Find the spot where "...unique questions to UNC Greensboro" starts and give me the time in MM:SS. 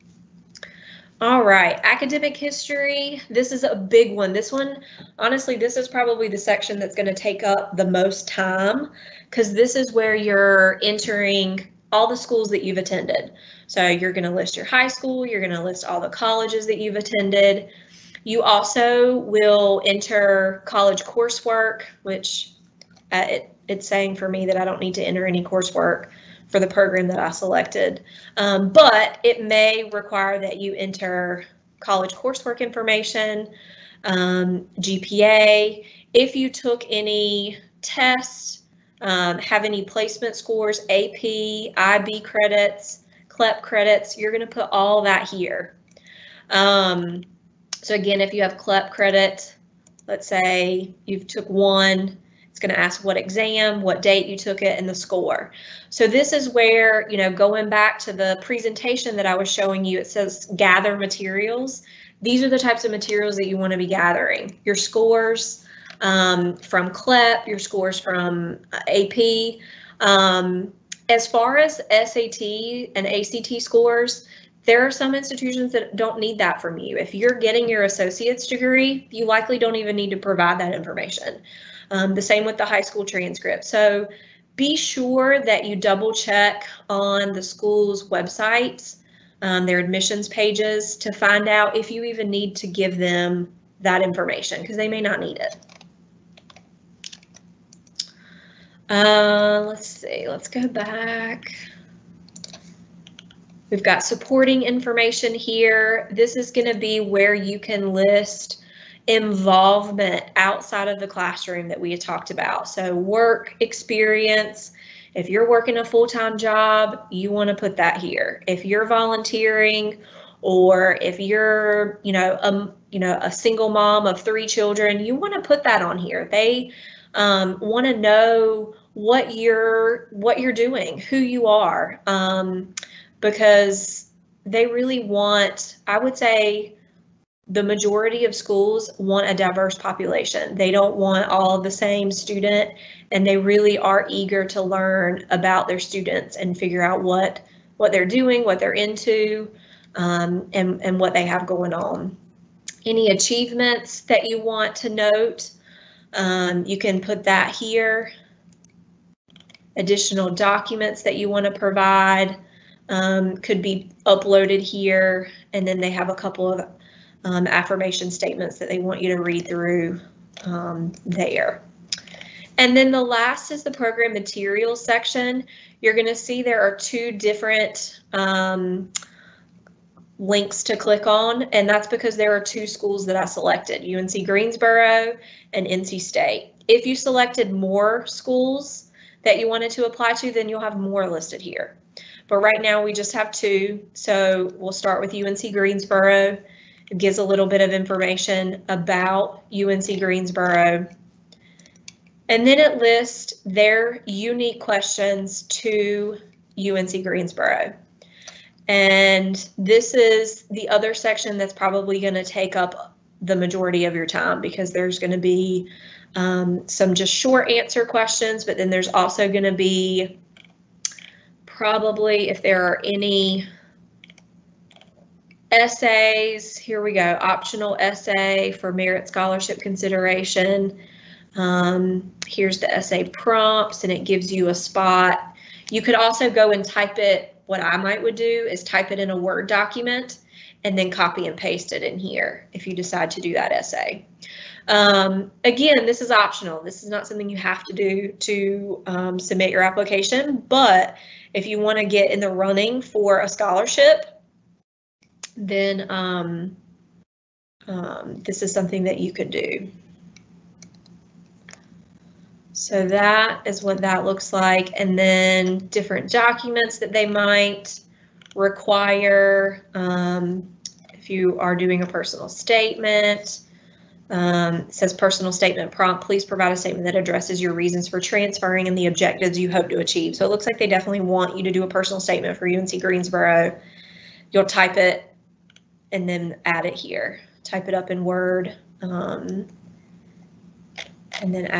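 03:24.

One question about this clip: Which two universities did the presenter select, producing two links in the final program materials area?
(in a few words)
UNC Greensboro and NC State.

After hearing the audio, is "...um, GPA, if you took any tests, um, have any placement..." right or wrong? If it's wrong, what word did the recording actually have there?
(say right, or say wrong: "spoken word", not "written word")
right.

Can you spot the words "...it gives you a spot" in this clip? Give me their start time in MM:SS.
03:53.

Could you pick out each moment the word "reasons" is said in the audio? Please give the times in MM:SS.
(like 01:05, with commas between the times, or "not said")
04:37.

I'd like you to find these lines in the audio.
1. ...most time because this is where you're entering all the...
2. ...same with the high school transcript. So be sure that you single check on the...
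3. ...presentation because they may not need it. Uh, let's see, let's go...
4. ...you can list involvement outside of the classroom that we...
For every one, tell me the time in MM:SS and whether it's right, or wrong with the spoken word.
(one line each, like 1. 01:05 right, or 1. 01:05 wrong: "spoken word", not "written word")
1. 00:07 right
2. 01:22 wrong: "double", not "single"
3. 01:34 wrong: "information", not "presentation"
4. 01:47 right.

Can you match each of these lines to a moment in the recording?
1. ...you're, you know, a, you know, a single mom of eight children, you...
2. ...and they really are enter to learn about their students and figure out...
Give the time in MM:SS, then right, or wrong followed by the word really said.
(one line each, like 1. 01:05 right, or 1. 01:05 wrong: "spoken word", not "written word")
1. 02:01 wrong: "three", not "eight"
2. 02:23 wrong: "eager", not "enter".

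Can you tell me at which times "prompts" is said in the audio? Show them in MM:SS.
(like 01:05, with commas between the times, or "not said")
03:53, 04:35.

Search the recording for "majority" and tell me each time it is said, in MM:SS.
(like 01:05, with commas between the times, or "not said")
02:17, 03:33.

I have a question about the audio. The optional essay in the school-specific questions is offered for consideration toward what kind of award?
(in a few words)
merit scholarship.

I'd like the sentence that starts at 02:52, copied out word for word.
And then the last is the program materials section.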